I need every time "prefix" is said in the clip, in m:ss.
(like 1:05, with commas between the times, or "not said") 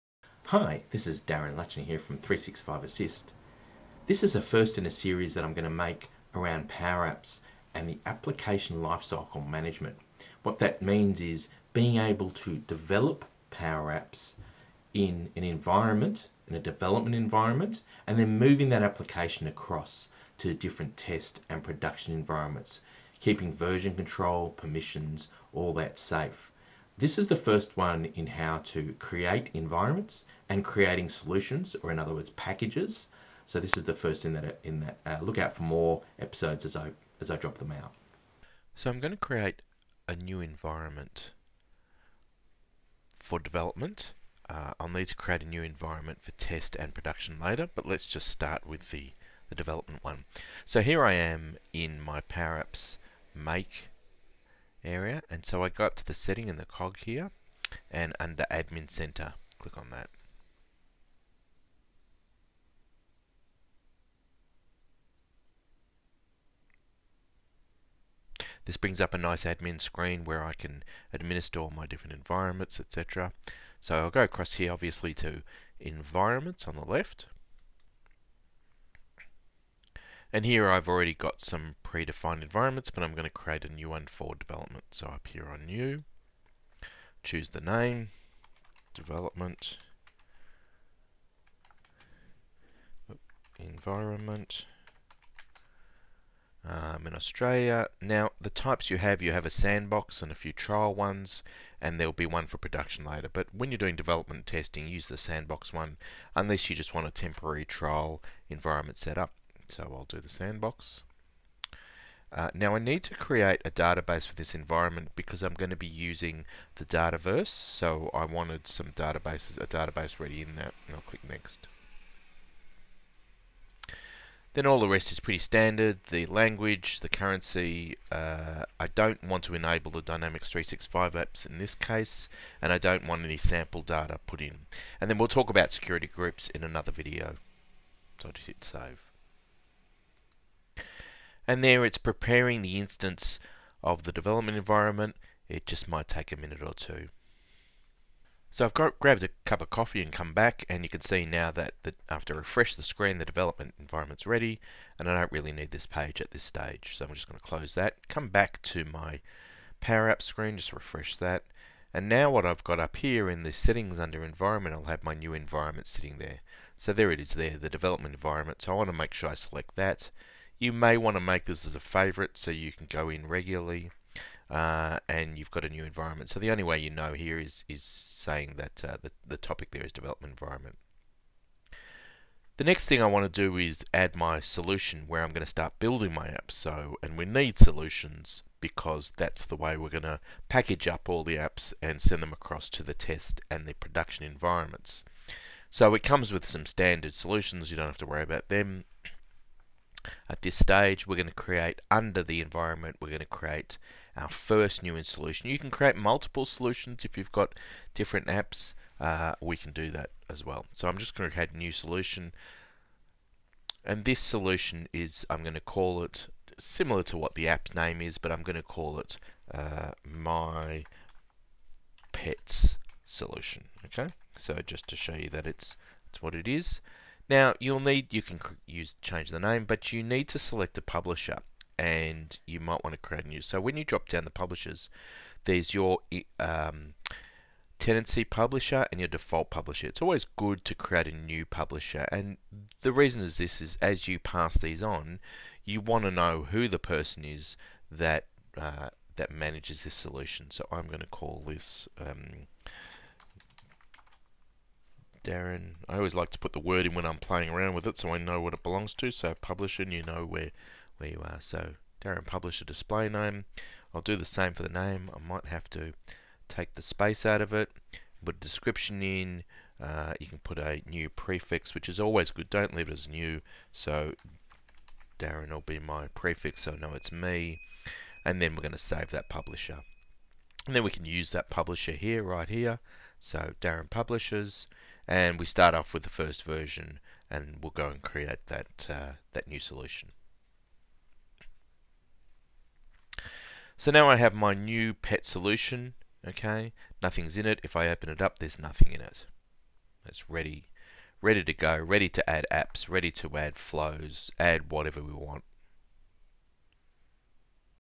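4:31, 4:36.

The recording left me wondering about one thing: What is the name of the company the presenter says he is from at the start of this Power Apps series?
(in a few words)
365 Assist.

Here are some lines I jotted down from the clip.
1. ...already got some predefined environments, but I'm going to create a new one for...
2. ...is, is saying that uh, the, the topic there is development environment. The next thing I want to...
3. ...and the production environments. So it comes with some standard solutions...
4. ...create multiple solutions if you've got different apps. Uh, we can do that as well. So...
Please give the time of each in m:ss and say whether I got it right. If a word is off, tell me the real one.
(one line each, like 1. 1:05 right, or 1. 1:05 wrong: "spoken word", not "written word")
1. 1:20 right
2. 2:57 right
3. 3:13 right
4. 3:25 right.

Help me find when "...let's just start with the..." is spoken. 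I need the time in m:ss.
0:47.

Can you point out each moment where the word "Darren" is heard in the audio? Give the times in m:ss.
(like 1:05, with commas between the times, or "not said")
0:01, 4:15, 4:22, 4:35, 4:43.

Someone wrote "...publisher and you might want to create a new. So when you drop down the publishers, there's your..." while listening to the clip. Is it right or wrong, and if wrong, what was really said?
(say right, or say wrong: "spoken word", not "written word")
right.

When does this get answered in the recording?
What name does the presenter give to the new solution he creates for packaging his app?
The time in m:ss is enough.
3:40.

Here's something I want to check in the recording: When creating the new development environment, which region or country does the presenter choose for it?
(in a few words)
Australia.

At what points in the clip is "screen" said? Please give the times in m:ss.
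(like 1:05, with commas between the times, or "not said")
1:09, 2:32, 2:40.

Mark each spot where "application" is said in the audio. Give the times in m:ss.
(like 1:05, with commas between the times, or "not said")
0:08, 0:18.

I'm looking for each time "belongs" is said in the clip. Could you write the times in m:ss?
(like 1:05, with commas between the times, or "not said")
4:18.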